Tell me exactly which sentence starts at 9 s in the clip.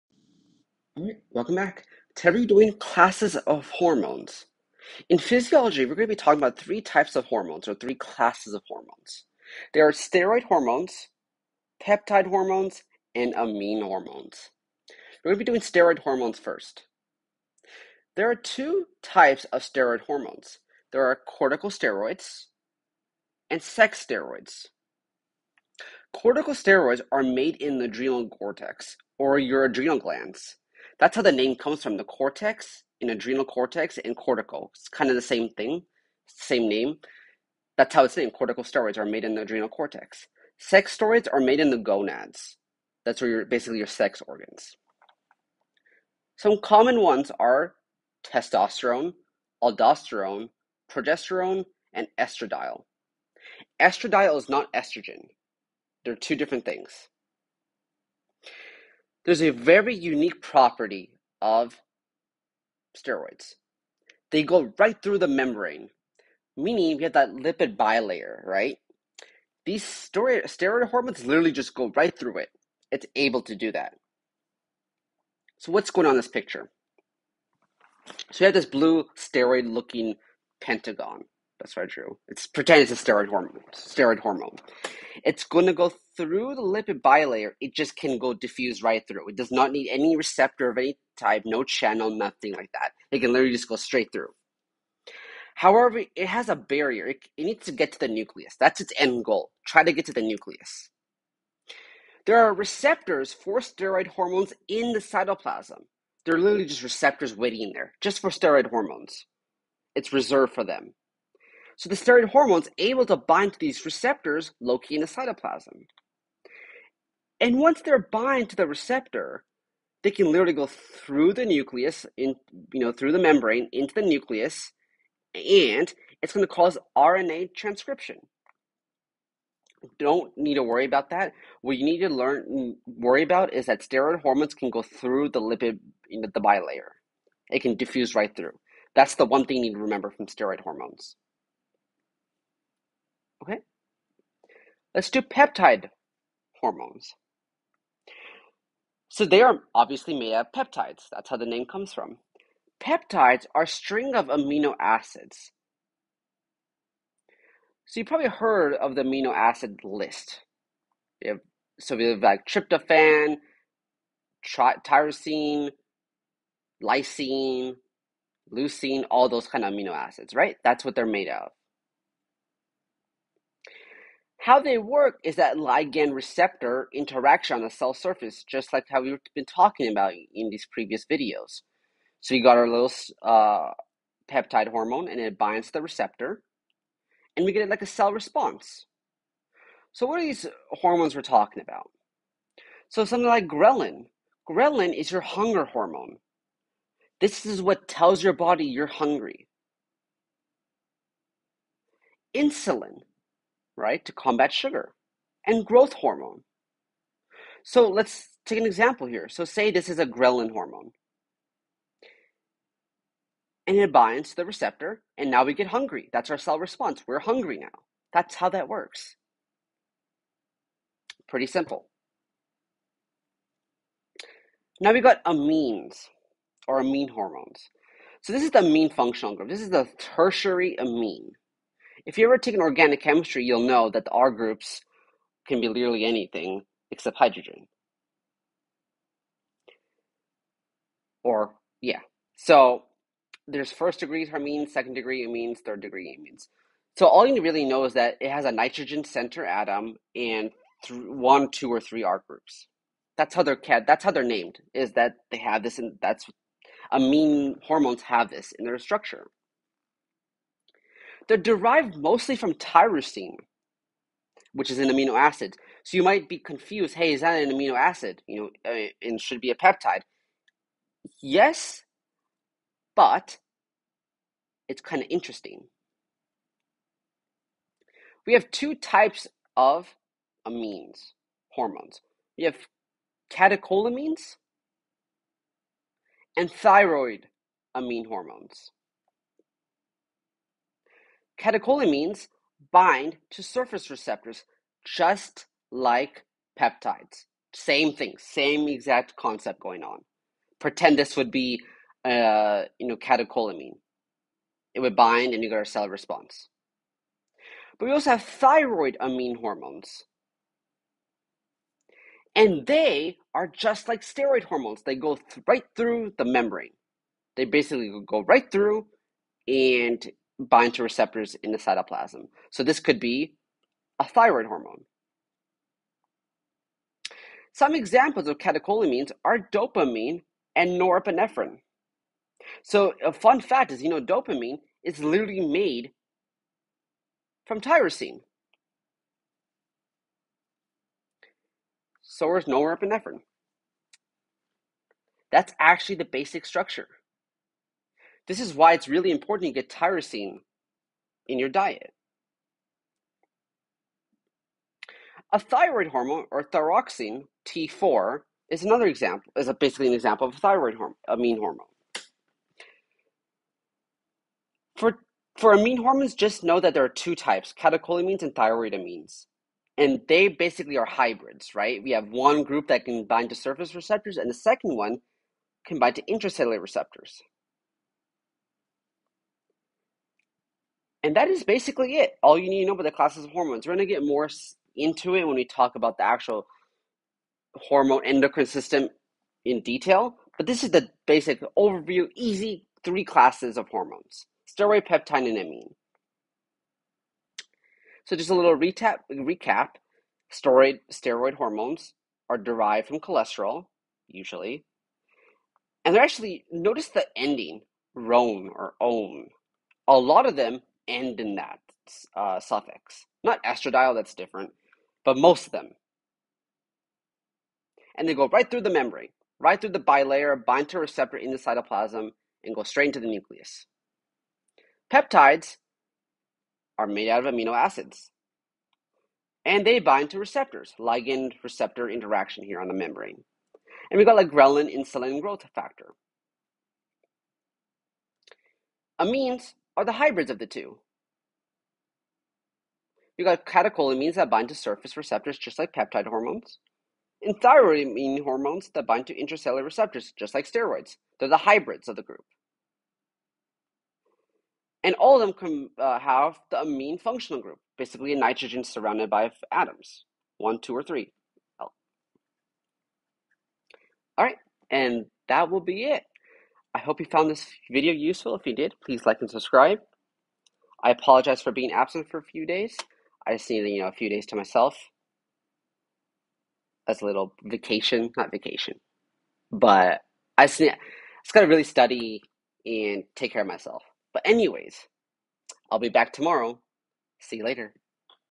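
There are steroid hormones, peptide hormones, and amine hormones.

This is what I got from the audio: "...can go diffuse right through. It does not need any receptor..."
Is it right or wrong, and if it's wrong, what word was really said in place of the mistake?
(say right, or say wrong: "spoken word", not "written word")
right.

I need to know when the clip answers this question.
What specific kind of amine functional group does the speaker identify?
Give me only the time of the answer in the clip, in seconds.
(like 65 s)
229 s.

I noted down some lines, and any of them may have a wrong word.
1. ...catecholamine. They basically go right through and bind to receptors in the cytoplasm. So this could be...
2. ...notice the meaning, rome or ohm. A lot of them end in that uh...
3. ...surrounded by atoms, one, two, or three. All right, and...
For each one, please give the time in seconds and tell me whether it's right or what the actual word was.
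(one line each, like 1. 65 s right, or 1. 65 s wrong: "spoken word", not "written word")
1. 316 s wrong: "membrane", not "catecholamine"
2. 406 s wrong: "ending", not "meaning"
3. 458 s right.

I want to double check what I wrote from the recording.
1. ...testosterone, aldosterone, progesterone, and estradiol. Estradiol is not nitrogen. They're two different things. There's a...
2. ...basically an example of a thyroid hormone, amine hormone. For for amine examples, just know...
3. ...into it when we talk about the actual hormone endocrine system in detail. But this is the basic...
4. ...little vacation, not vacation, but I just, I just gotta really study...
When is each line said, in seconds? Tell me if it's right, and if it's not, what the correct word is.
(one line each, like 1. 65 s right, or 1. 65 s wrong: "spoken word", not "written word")
1. 48 s wrong: "estrogen", not "nitrogen"
2. 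359 s wrong: "hormones", not "examples"
3. 384 s right
4. 477 s right.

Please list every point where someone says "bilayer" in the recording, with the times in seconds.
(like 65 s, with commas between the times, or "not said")
67 s, 87 s, 136 s, 419 s.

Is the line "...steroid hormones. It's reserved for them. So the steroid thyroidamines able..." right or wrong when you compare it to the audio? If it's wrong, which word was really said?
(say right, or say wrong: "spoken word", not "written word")
wrong: "hormones", not "thyroidamines".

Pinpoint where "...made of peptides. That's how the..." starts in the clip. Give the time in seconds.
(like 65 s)
150 s.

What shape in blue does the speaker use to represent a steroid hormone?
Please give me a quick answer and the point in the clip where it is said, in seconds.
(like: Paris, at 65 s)
Pentagon, at 80 s.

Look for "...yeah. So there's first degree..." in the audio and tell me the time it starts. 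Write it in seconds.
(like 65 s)
241 s.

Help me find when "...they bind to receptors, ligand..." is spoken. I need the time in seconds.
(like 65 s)
429 s.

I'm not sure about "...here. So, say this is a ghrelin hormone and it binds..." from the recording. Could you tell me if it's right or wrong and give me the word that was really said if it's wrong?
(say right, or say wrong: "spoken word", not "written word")
right.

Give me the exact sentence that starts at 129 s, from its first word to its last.
Don't need to worry about that.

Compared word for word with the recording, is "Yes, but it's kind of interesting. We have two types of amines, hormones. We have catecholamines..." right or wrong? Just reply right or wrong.
right.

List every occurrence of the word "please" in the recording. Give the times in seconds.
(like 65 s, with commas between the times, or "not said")
468 s.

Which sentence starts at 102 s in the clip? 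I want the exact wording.
There are receptors for steroid hormones in the cytoplasm.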